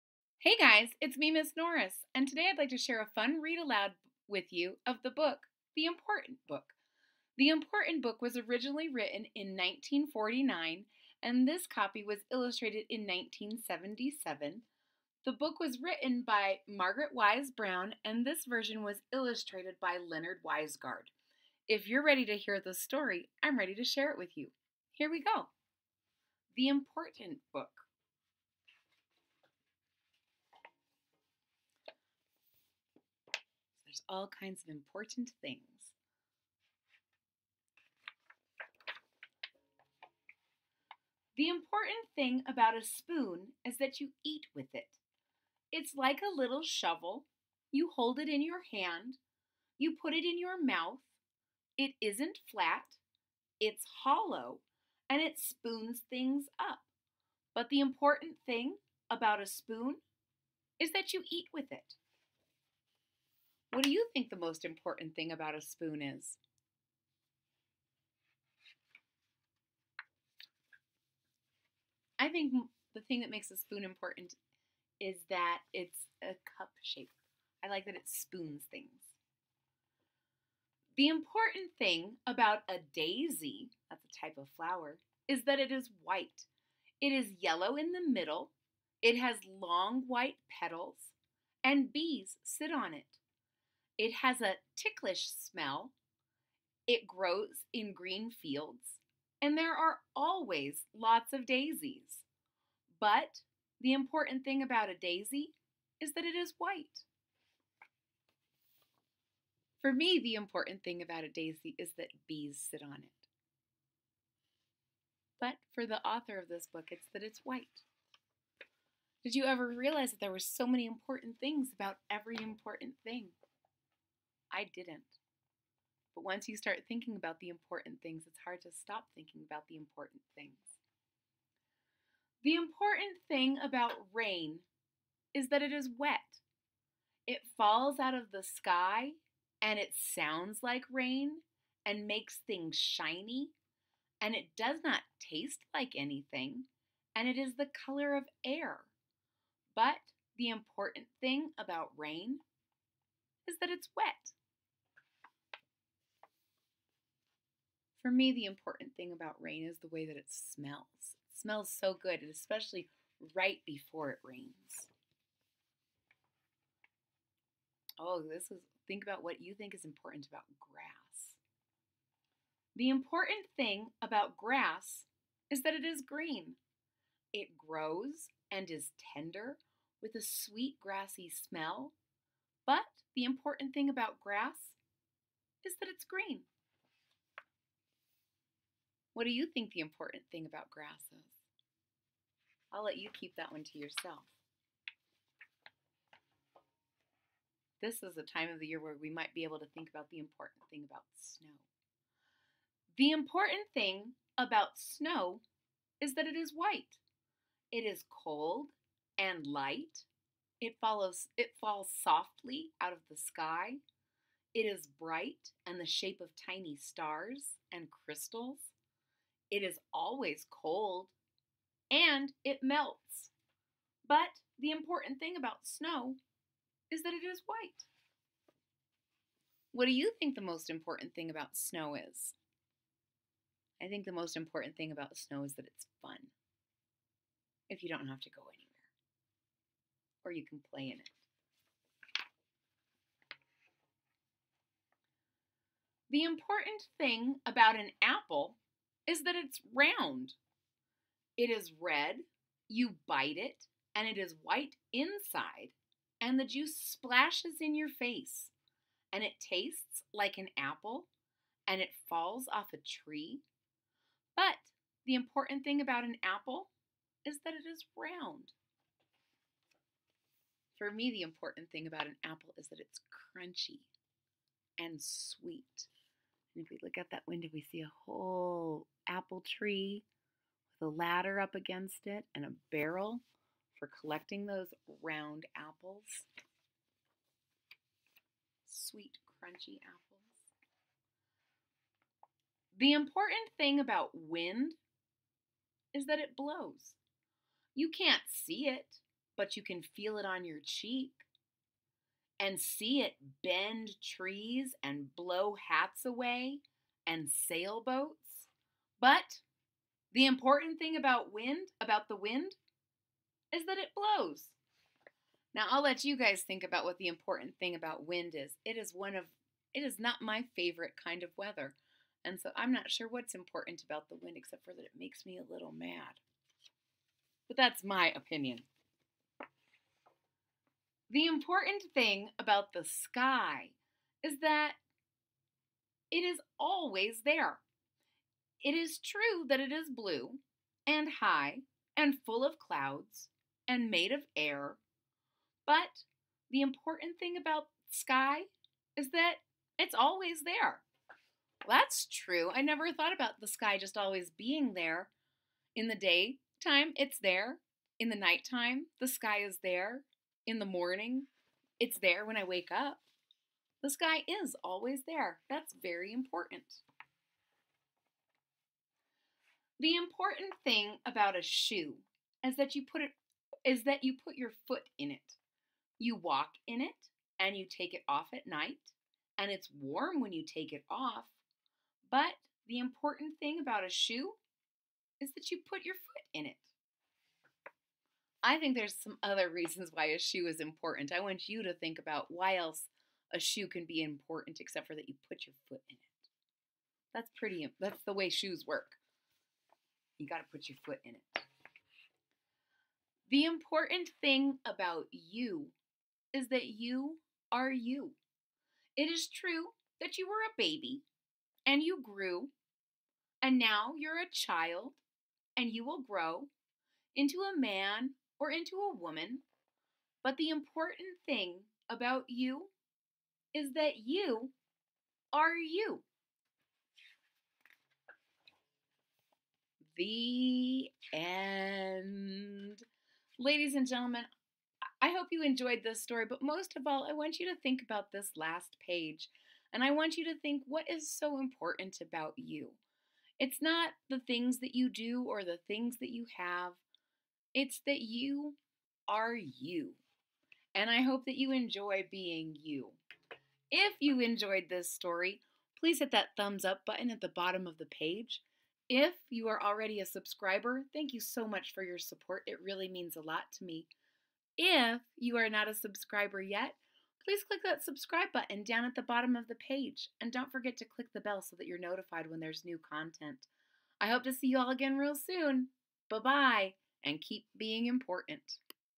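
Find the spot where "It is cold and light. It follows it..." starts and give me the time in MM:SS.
03:27.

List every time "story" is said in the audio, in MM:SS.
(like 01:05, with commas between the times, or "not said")
00:22, 07:16, 07:34.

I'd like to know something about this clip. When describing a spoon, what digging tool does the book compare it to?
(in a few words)
A little shovel.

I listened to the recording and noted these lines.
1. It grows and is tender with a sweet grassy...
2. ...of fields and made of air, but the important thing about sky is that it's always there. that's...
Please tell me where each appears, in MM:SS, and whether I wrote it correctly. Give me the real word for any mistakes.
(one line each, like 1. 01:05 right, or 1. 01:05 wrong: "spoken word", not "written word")
1. 02:57 right
2. 05:42 wrong: "clouds", not "fields".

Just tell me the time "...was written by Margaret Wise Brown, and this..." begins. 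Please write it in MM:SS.
00:15.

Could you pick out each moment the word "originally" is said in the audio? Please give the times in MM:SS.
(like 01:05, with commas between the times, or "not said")
00:08.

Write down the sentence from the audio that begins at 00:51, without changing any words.
It isn't flat, it's hollow, and it spoons things up.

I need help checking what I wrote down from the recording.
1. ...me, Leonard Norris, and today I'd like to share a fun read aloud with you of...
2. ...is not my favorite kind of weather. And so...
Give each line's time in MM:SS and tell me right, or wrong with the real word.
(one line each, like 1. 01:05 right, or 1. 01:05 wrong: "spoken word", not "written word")
1. 00:01 wrong: "Miss", not "Leonard"
2. 05:19 right.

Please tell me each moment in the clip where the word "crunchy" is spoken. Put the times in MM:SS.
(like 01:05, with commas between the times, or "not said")
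04:33, 04:49.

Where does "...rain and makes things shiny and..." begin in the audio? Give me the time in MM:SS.
02:20.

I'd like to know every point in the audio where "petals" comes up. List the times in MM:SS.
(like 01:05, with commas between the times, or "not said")
01:30.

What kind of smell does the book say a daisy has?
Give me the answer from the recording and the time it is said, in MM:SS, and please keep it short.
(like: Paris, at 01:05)
Ticklish, at 01:34.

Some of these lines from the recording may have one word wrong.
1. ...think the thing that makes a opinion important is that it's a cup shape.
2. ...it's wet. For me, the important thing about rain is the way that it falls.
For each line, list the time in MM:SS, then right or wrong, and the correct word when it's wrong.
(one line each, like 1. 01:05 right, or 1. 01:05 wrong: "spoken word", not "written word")
1. 01:12 wrong: "spoon", not "opinion"
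2. 02:33 wrong: "smells", not "falls".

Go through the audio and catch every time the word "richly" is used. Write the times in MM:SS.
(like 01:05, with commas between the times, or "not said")
not said.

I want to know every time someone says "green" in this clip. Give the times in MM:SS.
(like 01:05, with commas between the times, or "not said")
01:37, 02:56, 03:06.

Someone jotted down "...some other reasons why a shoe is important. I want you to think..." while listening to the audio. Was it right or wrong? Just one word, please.
right.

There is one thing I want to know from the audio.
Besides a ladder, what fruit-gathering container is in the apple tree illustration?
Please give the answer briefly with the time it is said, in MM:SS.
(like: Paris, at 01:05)
A barrel, at 04:42.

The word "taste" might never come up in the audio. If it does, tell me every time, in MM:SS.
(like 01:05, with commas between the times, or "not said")
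02:25, 04:19.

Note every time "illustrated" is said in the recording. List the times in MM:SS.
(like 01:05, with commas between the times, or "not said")
00:12, 00:19.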